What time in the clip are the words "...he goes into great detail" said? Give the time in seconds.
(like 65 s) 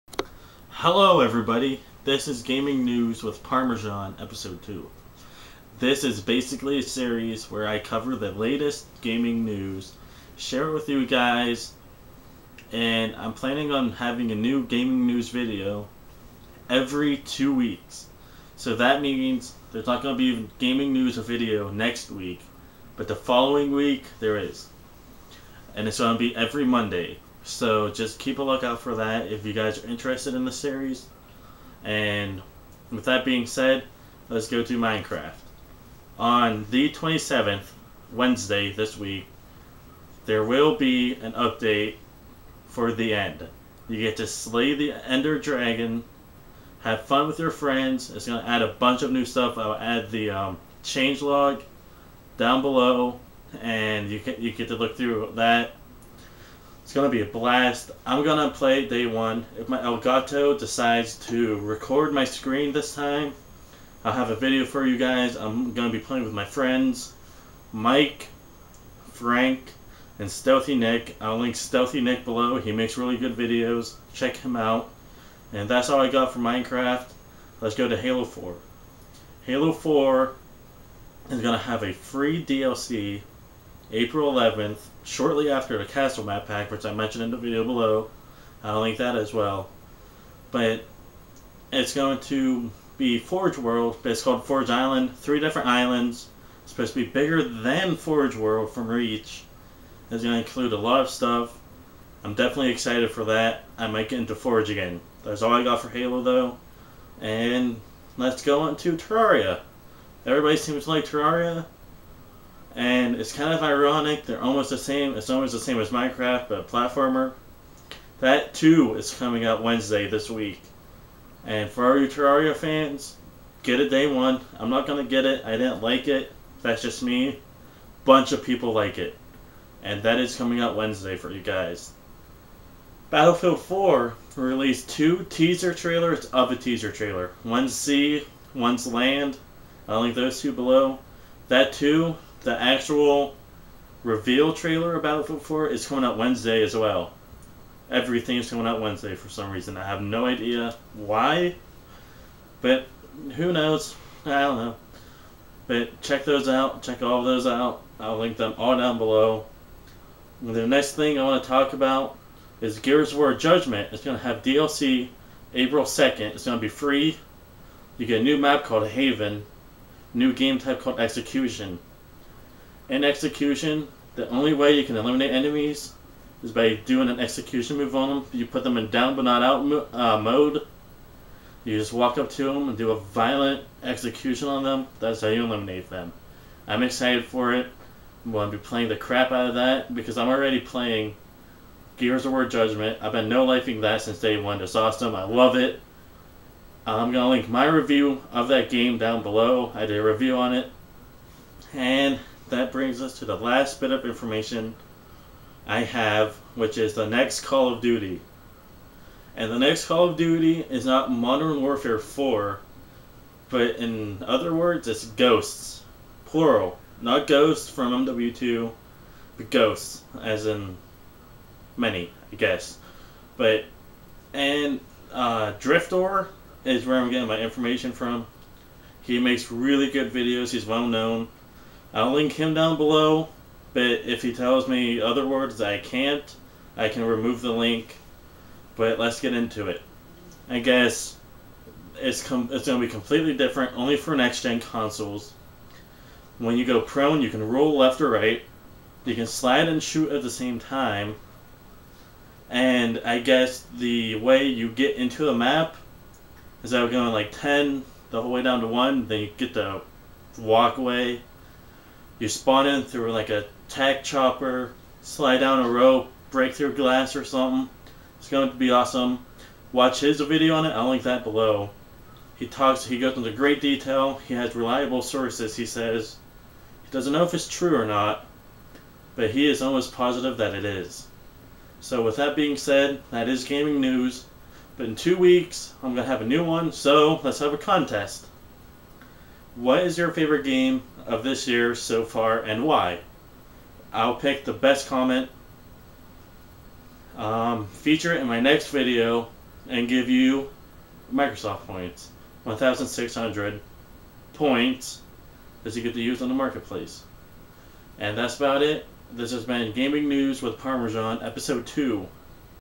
272 s.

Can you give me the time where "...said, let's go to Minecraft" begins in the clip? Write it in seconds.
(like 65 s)
33 s.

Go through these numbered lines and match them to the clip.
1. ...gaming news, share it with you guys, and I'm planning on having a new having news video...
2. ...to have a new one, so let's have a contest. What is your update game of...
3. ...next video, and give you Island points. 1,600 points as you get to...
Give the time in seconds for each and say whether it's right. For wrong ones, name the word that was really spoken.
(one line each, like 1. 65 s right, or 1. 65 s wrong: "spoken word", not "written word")
1. 9 s wrong: "gaming", not "having"
2. 286 s wrong: "favorite", not "update"
3. 298 s wrong: "Microsoft", not "Island".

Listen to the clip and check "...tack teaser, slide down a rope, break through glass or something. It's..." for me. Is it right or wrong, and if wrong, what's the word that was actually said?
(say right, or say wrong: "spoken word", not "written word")
wrong: "chopper", not "teaser".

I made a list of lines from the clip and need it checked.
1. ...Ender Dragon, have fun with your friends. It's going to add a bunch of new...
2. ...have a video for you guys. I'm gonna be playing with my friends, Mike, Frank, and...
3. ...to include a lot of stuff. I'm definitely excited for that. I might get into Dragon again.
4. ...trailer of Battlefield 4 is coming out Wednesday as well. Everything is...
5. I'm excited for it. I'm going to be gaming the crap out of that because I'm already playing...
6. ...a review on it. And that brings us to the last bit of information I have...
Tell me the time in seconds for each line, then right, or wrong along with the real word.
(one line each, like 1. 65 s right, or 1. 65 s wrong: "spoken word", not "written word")
1. 44 s right
2. 64 s right
3. 100 s wrong: "Forge", not "Dragon"
4. 144 s right
5. 186 s wrong: "playing", not "gaming"
6. 199 s right.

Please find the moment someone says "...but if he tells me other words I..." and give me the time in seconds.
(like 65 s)
233 s.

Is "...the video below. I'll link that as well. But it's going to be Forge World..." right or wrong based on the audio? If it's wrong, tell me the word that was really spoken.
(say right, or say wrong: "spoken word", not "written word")
right.